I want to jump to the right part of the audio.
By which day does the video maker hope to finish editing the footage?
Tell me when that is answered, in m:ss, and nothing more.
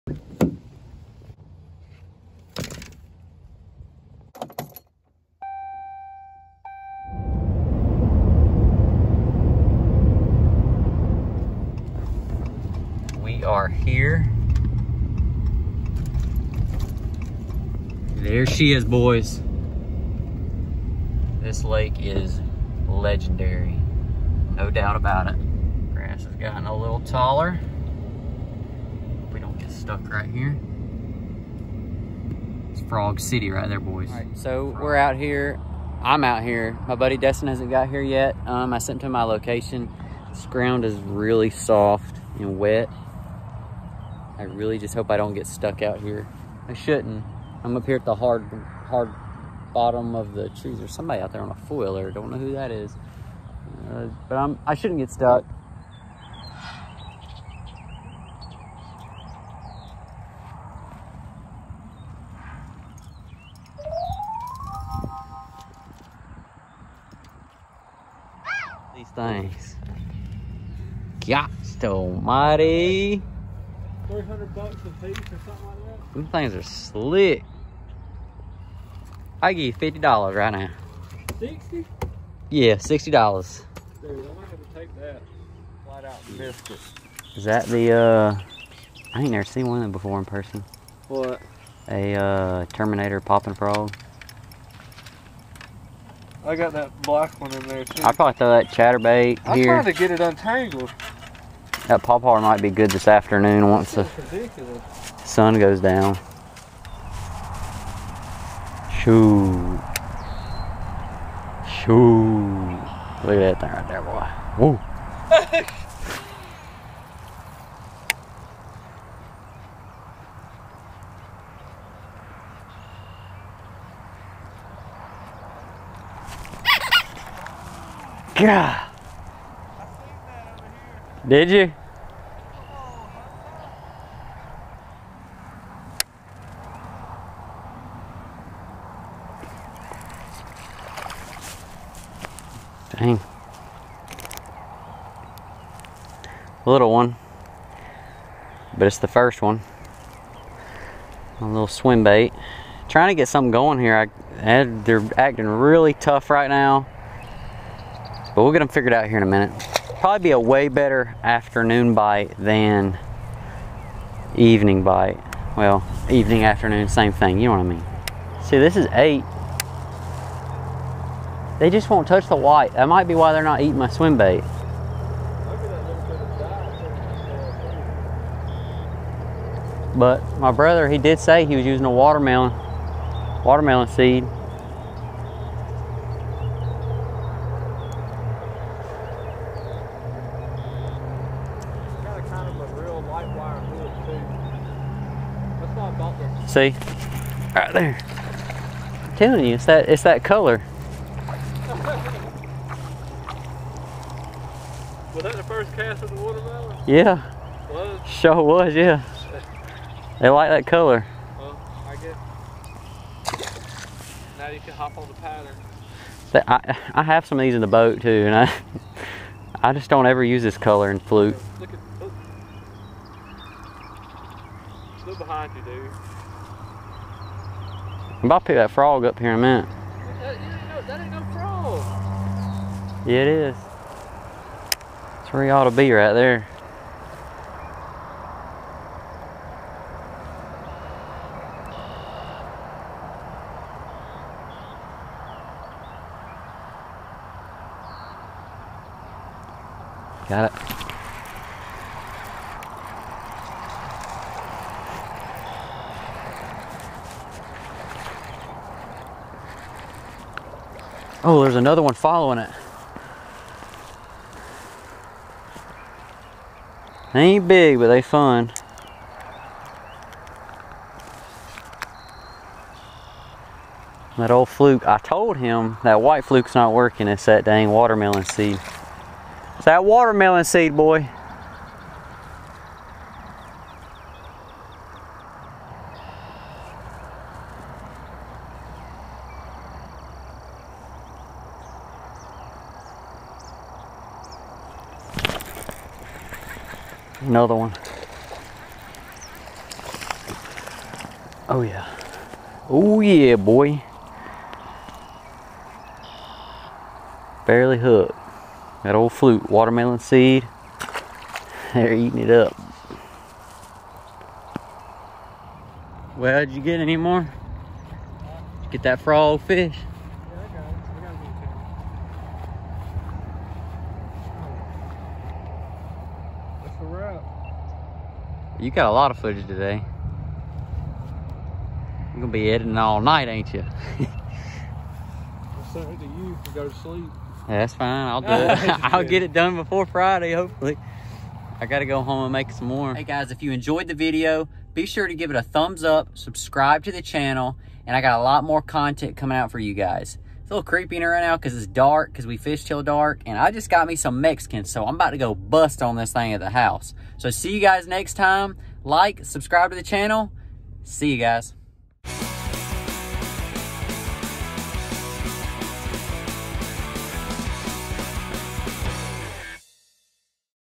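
5:39.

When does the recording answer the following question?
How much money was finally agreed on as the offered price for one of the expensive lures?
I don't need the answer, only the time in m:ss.
1:22.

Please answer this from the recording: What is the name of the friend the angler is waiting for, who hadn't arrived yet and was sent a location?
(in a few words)
Destin.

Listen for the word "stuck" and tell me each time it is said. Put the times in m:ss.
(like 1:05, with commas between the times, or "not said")
0:29, 0:45, 0:55.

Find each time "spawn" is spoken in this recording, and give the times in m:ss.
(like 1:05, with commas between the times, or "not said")
not said.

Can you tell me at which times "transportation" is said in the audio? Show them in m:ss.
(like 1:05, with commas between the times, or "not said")
not said.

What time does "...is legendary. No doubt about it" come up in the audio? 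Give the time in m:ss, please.
0:21.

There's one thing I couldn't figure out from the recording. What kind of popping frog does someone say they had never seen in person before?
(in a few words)
Terminator.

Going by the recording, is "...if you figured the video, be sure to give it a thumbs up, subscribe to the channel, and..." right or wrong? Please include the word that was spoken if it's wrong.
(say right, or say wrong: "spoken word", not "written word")
wrong: "enjoyed", not "figured".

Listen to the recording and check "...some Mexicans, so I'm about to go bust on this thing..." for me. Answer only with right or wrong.
right.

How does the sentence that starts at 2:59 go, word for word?
But my brother, he did say he was using a watermelon, watermelon seed.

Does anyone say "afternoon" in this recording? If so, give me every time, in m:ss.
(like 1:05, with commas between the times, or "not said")
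1:43, 2:41, 2:46.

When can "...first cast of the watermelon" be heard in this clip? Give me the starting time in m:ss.
3:25.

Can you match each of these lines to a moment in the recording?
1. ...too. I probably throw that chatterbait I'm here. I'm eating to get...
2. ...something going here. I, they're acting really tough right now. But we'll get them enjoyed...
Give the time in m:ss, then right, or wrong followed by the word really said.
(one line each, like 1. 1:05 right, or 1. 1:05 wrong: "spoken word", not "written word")
1. 1:37 wrong: "trying", not "eating"
2. 2:33 wrong: "figured", not "enjoyed".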